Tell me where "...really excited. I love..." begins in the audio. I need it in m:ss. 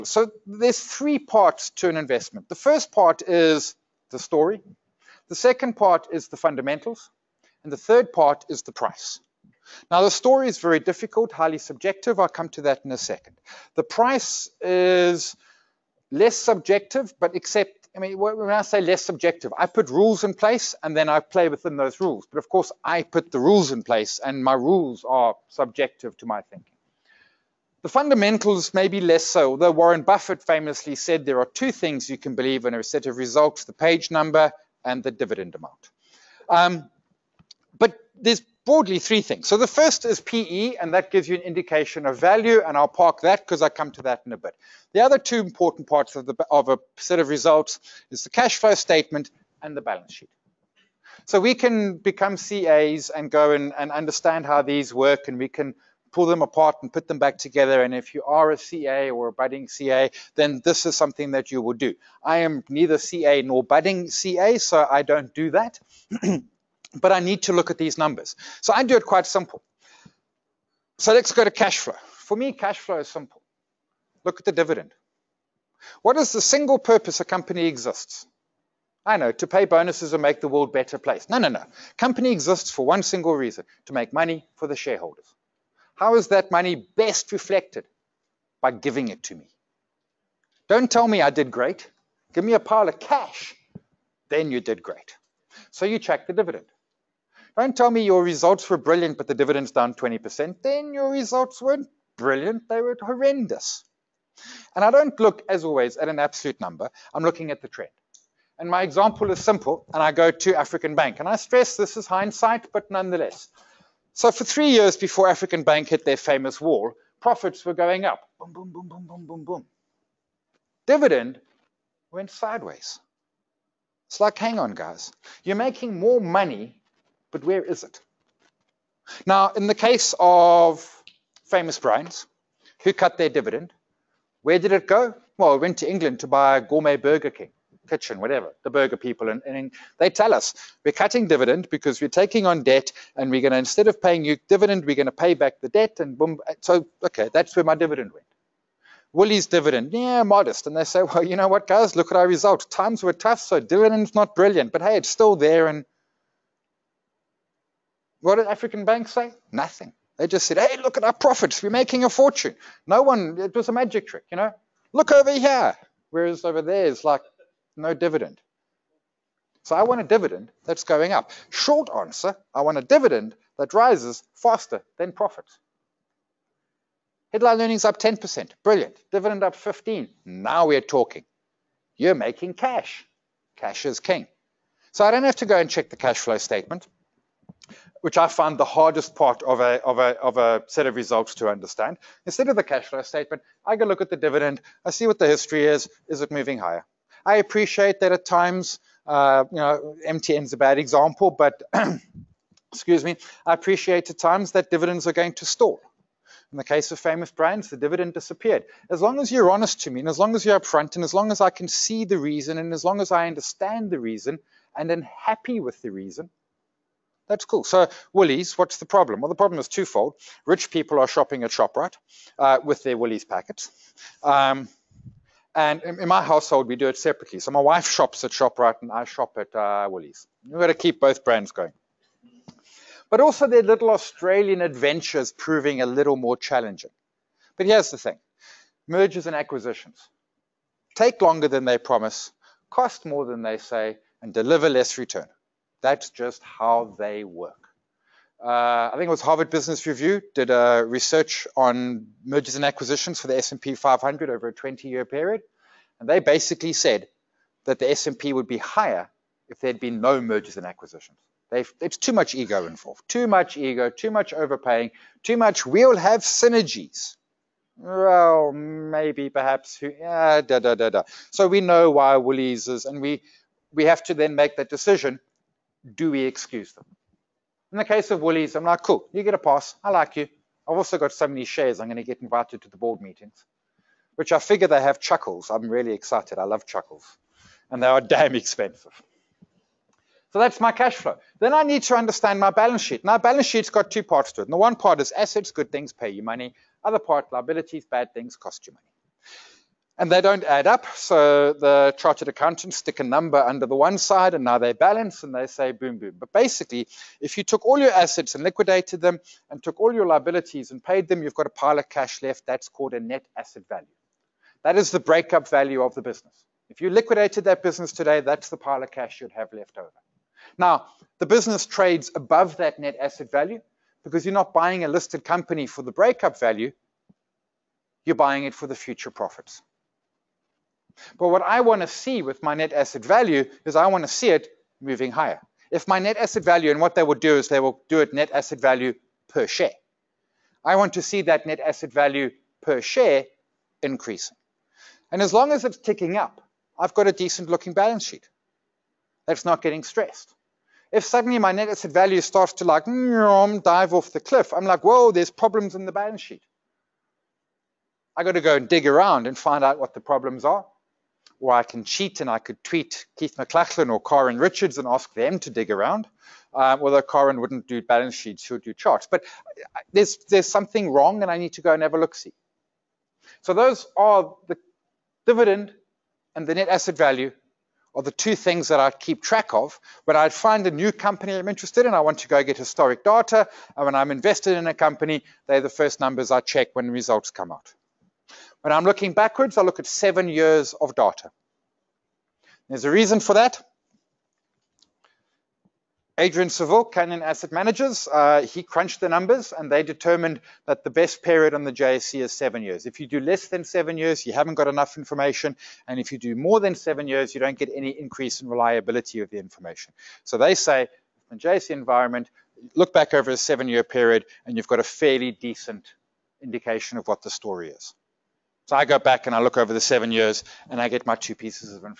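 4:45.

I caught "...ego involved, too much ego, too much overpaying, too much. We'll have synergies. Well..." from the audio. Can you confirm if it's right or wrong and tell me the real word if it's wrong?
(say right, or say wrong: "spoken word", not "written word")
right.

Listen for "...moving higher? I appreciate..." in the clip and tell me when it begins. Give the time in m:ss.
3:16.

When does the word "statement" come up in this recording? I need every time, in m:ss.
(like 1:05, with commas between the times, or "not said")
0:48, 3:06, 3:13.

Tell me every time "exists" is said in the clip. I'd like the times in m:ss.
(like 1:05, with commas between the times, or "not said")
1:17, 1:22.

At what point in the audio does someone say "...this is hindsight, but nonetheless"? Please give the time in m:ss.
1:51.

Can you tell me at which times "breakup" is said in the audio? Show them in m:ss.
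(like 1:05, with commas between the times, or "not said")
5:15, 5:25.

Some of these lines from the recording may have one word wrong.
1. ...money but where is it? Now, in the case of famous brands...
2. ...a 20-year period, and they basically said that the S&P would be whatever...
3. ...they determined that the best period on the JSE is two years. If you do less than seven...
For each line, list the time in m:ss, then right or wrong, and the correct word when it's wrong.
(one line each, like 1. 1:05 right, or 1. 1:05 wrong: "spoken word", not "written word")
1. 2:06 right
2. 4:14 wrong: "higher", not "whatever"
3. 6:39 wrong: "seven", not "two".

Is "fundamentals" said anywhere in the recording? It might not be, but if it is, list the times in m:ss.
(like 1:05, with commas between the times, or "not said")
0:06, 0:27.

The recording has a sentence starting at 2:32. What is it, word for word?
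Times were tough, so dividend's not brilliant, but hey, it's still there.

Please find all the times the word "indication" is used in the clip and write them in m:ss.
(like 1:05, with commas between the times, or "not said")
0:41, 6:56.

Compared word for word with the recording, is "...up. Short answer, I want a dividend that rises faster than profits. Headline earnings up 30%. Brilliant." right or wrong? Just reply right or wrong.
wrong.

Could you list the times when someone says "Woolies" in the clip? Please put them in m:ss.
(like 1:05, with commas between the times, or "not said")
2:29, 3:38, 3:42, 3:49, 4:32, 4:38.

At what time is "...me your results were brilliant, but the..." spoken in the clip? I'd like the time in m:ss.
1:37.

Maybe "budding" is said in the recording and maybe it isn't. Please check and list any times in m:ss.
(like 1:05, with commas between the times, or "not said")
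0:59, 1:03.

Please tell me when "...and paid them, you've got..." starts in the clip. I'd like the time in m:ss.
5:10.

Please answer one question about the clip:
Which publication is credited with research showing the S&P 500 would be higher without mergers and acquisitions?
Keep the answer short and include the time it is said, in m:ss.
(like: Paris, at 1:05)
Harvard Business Review, at 4:09.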